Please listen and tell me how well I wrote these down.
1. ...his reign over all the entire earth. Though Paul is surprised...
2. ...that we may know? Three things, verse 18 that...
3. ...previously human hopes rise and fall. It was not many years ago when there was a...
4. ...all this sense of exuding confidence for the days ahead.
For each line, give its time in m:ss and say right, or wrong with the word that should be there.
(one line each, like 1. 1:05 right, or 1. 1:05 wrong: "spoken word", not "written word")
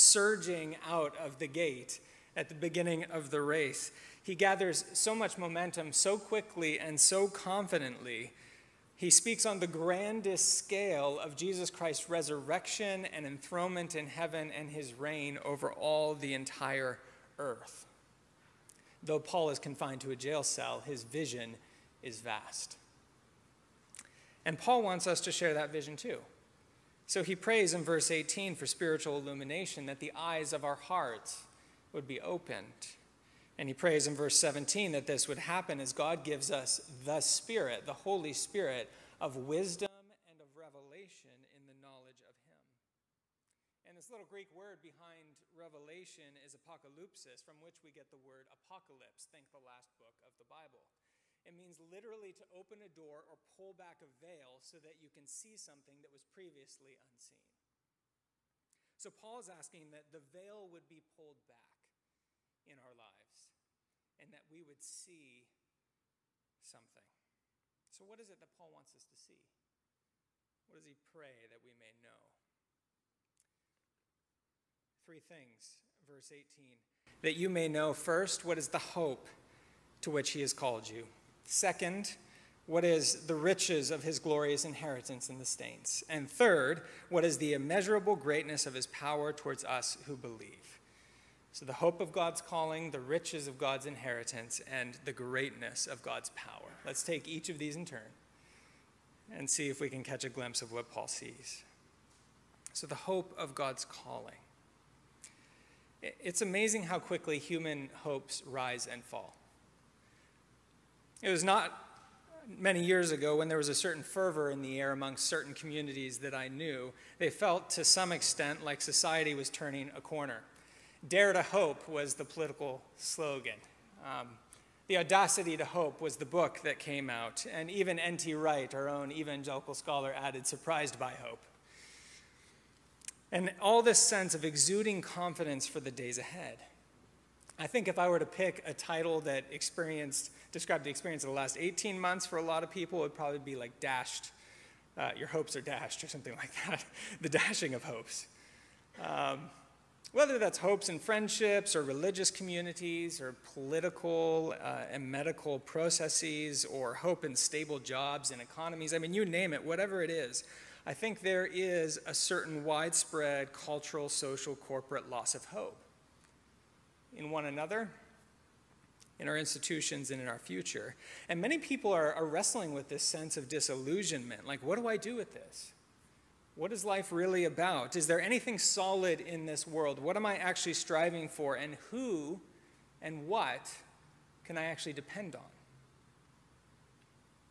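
1. 0:14 wrong: "confined", not "surprised"
2. 1:11 right
3. 1:46 wrong: "quickly", not "previously"
4. 2:13 right.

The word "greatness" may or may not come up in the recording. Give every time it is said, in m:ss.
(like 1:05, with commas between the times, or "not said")
1:28, 1:35.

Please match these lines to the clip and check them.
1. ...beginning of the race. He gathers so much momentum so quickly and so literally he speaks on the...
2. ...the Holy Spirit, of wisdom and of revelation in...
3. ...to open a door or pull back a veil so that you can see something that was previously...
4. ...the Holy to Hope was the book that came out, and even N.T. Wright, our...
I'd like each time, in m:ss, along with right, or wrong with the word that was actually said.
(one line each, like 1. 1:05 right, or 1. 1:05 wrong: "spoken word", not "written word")
1. 0:02 wrong: "confidently", not "literally"
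2. 0:37 right
3. 0:52 right
4. 2:04 wrong: "Audacity", not "Holy".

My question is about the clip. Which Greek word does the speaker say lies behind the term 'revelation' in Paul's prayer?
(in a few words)
apocalypsis.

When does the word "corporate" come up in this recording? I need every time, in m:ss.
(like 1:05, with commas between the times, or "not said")
2:44.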